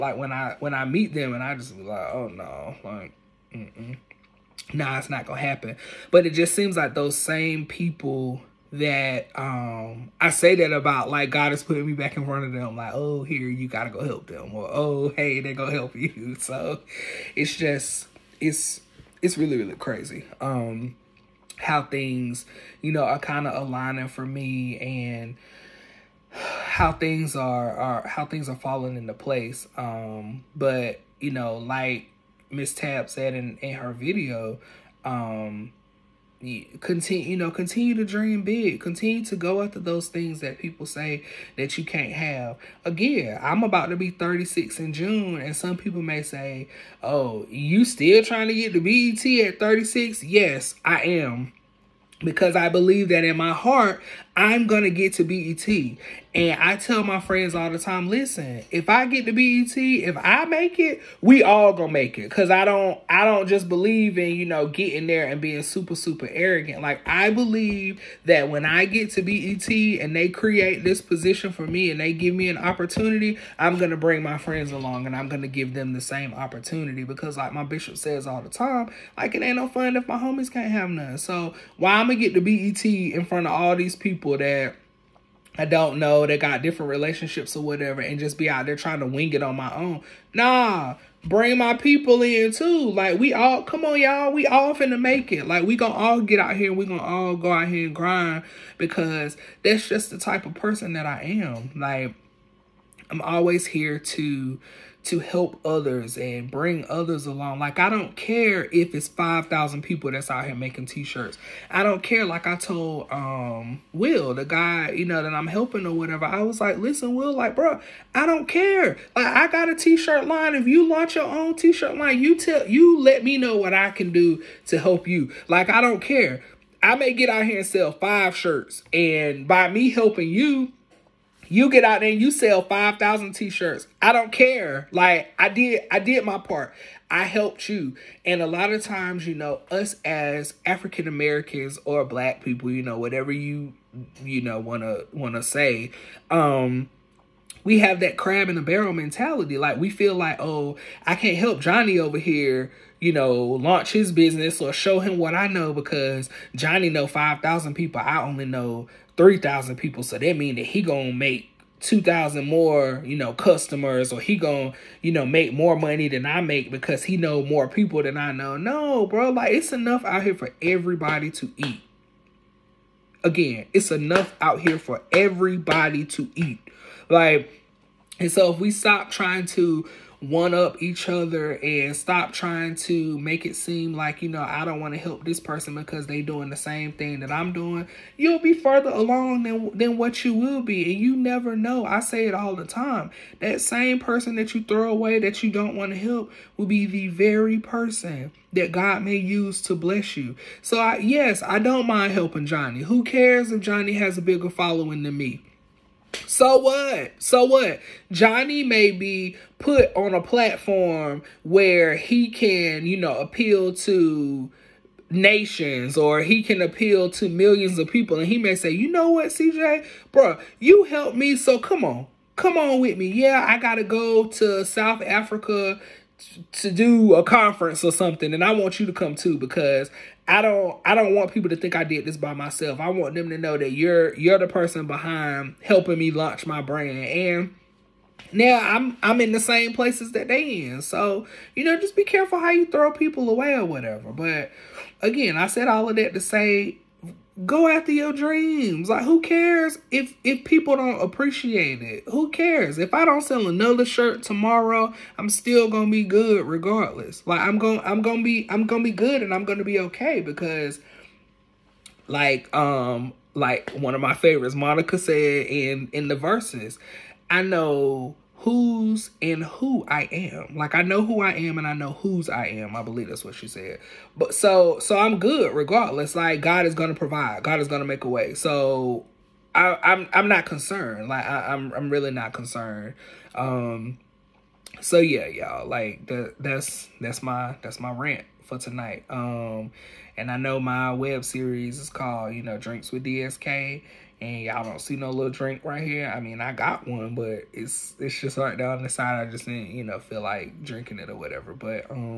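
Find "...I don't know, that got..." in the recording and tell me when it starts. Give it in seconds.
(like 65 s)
85 s.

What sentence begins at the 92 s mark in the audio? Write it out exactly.
Like we all, come on y'all, we all finna make it.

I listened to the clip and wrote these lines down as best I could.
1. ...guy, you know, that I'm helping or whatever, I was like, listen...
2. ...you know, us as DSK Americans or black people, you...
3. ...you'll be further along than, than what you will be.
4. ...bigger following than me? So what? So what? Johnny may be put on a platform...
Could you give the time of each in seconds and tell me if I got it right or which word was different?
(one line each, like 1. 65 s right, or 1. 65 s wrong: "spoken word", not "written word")
1. 114 s right
2. 139 s wrong: "African", not "DSK"
3. 188 s right
4. 204 s right.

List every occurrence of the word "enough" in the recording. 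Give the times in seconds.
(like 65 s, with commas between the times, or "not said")
169 s, 173 s.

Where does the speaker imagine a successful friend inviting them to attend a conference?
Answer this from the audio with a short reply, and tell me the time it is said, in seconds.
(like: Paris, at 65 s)
South Africa, at 224 s.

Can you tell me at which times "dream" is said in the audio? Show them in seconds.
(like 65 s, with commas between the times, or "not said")
38 s, 248 s.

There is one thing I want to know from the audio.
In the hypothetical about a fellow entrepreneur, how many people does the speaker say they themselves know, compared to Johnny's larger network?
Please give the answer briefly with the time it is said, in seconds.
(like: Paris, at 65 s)
3,000, at 159 s.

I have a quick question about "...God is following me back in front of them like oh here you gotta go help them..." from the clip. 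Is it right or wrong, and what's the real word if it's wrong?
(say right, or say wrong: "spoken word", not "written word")
wrong: "putting", not "following".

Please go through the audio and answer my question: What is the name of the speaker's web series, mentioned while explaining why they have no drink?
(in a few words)
Drinks with DSK.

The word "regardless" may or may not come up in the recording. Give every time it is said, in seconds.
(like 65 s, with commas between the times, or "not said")
256 s, 275 s.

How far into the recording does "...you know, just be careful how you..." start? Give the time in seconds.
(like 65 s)
241 s.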